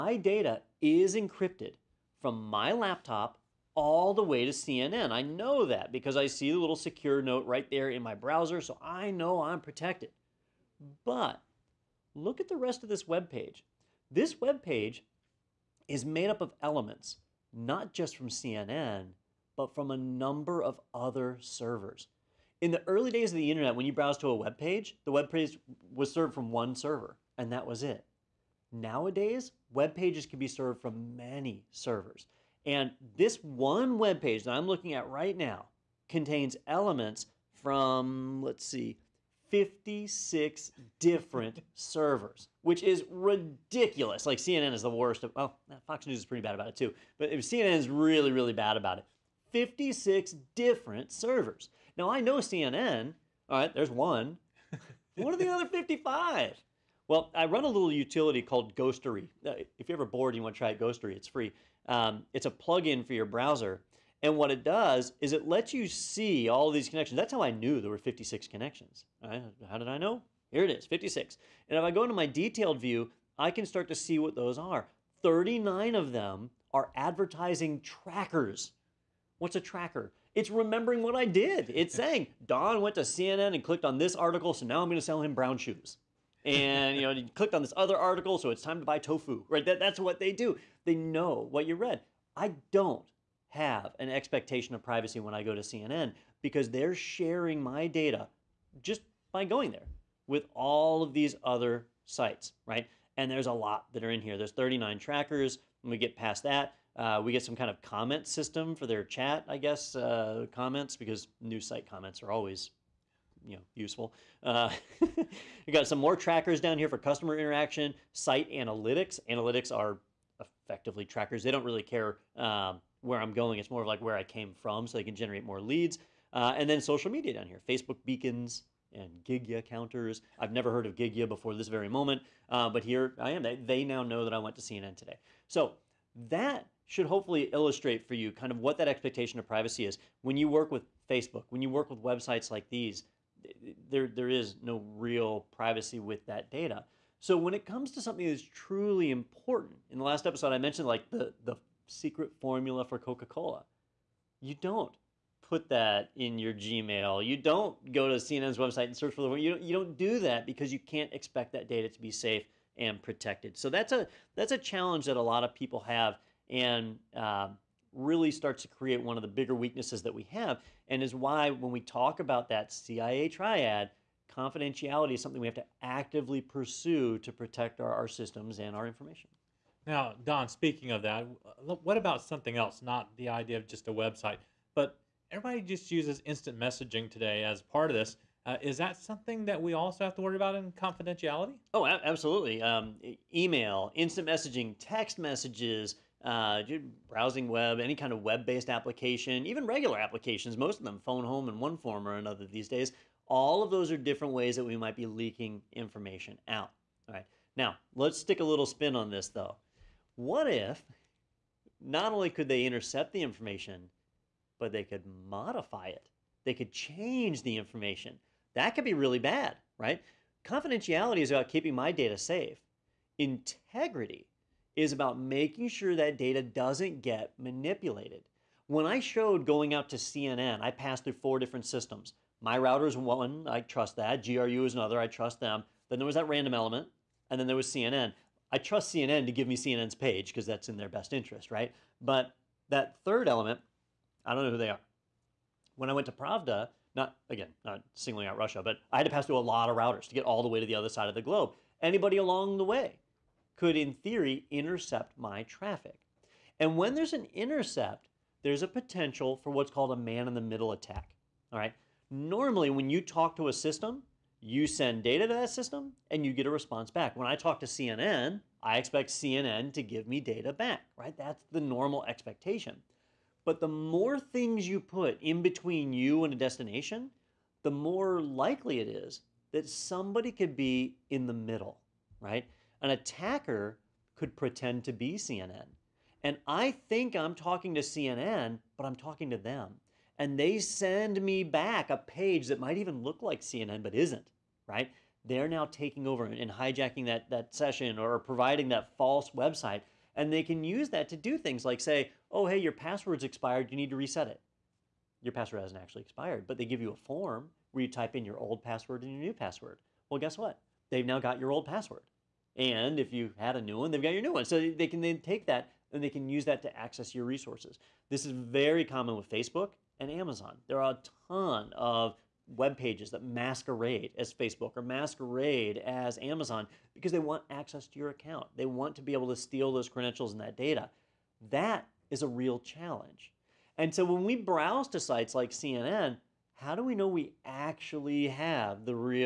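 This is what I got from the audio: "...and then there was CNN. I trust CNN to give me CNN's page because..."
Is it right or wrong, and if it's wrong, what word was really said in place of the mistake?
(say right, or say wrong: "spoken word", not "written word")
right.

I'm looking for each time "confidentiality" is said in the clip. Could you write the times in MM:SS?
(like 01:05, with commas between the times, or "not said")
02:54, 03:10, 03:40.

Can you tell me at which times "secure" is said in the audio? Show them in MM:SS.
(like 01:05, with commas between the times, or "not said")
00:06.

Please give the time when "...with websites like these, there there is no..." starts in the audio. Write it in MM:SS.
02:21.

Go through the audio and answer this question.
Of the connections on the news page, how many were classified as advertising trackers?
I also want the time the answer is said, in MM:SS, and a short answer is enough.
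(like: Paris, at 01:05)
39, at 01:15.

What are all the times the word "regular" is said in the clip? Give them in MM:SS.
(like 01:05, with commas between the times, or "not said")
03:19.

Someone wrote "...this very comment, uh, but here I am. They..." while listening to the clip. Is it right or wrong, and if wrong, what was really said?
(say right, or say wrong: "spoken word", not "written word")
wrong: "moment", not "comment".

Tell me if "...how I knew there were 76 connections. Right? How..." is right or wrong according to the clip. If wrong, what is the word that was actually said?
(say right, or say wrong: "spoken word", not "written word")
wrong: "56", not "76".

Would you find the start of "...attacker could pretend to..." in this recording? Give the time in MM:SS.
04:42.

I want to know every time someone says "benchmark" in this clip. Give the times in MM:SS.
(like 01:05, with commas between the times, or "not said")
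not said.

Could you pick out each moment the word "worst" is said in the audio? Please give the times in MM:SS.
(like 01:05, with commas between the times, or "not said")
00:44.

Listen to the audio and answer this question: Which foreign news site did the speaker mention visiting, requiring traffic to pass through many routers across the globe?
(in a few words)
Pravda.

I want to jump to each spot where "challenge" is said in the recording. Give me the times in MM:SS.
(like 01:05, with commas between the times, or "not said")
02:44, 05:32.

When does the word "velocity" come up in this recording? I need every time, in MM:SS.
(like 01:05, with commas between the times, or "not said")
not said.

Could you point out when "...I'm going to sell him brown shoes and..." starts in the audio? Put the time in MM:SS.
01:24.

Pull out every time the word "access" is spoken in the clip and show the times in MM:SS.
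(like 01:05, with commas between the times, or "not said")
05:16, 05:27.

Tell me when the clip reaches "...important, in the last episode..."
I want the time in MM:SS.
02:29.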